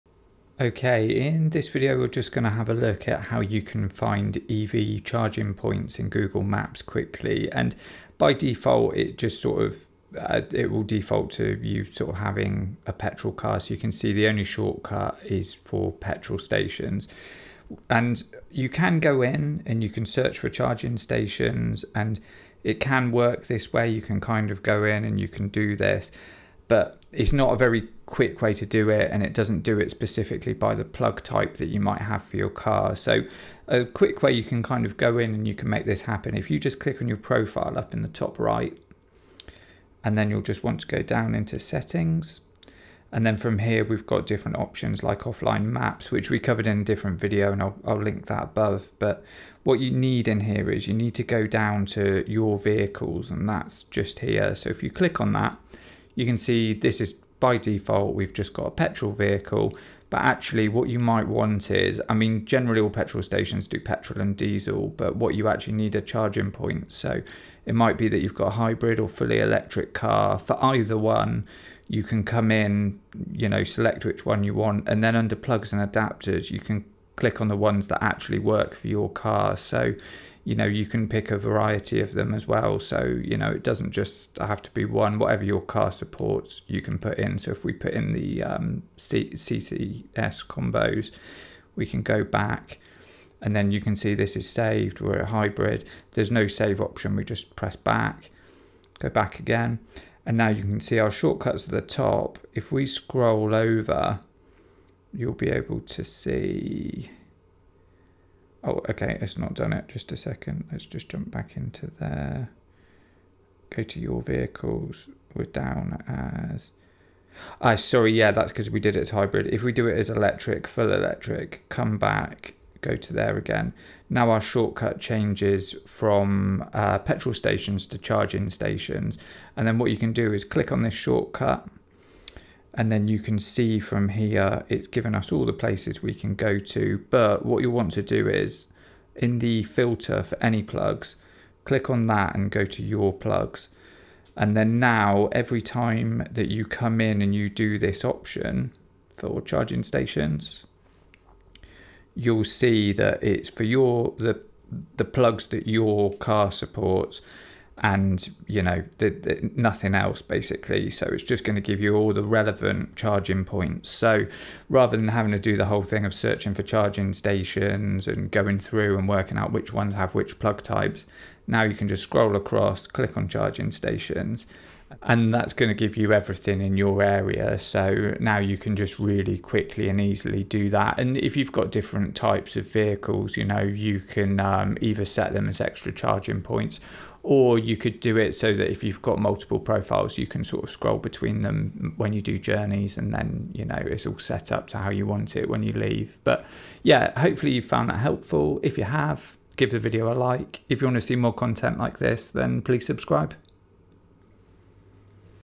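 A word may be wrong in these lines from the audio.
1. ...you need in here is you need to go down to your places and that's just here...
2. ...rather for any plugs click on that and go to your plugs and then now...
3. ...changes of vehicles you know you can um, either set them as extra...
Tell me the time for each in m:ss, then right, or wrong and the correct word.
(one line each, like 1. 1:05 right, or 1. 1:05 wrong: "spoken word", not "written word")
1. 0:49 wrong: "vehicles", not "places"
2. 2:19 wrong: "filter", not "rather"
3. 3:02 wrong: "types", not "changes".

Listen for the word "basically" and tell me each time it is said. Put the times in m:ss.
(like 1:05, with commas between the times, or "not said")
2:40.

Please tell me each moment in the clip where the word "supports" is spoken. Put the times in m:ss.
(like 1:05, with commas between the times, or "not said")
1:25, 2:36.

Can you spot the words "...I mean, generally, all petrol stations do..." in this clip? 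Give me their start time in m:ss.
1:02.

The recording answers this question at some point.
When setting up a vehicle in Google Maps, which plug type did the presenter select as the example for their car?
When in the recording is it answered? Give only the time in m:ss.
1:28.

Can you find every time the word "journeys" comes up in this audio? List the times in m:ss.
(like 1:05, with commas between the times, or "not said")
3:12.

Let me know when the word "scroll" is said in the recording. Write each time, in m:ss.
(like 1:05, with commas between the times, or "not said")
1:42, 2:52, 3:10.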